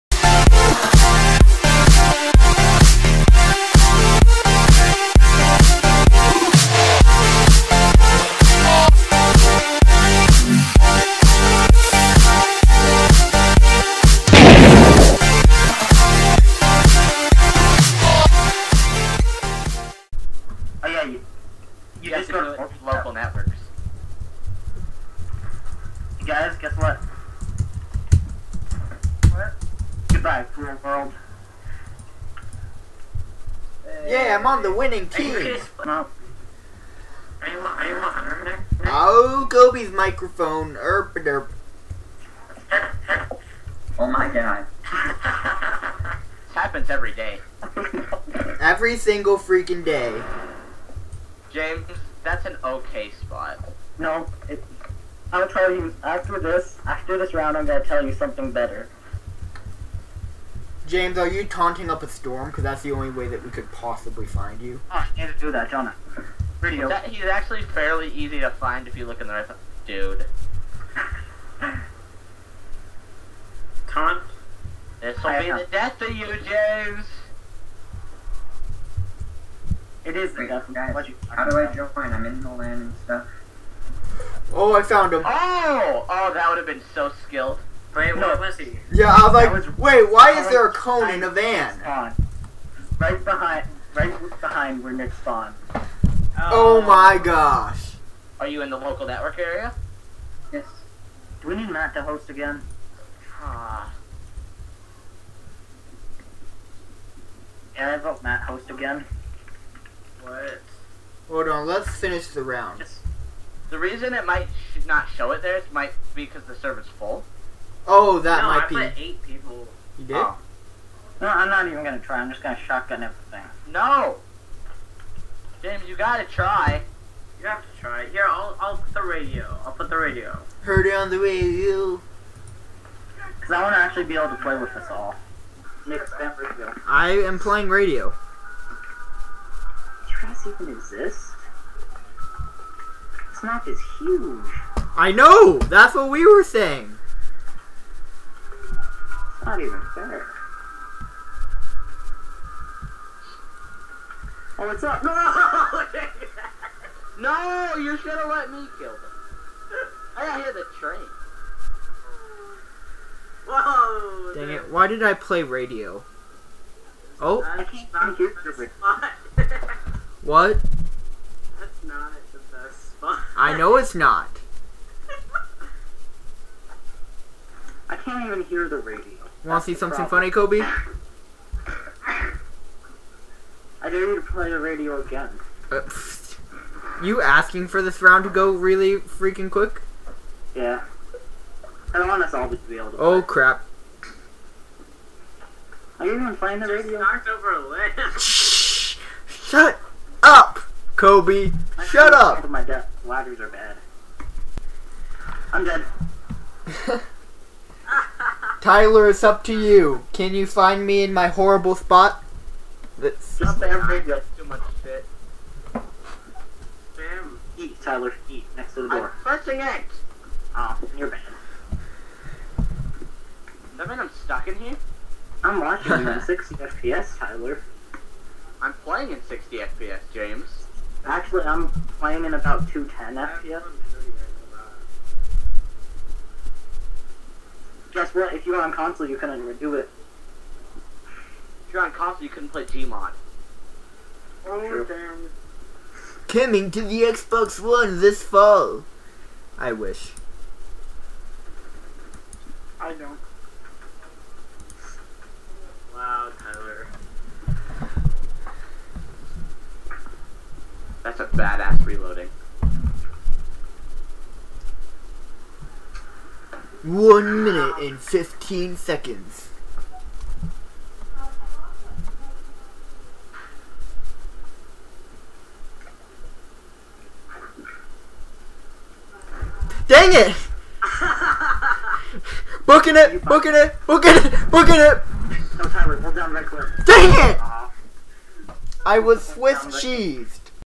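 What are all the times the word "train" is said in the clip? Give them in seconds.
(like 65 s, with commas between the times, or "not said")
160 s.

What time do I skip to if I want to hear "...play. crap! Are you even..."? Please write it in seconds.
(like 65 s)
193 s.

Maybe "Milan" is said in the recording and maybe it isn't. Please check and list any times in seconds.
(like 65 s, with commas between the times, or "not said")
not said.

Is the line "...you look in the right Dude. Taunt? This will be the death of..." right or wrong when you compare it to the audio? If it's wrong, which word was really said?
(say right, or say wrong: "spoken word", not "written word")
right.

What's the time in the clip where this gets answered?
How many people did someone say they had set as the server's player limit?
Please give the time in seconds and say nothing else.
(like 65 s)
119 s.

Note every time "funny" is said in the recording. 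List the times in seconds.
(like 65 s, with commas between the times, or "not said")
180 s.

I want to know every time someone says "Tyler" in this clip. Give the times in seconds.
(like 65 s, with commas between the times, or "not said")
208 s, 217 s, 227 s.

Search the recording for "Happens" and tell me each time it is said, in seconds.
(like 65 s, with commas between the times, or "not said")
46 s.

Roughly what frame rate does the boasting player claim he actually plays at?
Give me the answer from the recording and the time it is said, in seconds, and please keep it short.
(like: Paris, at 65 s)
210, at 232 s.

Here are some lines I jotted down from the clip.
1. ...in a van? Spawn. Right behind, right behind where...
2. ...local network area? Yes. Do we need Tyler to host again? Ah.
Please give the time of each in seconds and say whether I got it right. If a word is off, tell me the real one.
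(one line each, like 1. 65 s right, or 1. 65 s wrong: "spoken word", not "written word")
1. 91 s right
2. 98 s wrong: "Matt", not "Tyler".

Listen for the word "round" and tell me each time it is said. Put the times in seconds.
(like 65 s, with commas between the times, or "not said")
57 s, 112 s, 188 s.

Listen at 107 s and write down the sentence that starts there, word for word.
Yeah, I vote Matt host again.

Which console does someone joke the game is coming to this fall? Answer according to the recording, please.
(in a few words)
Xbox One.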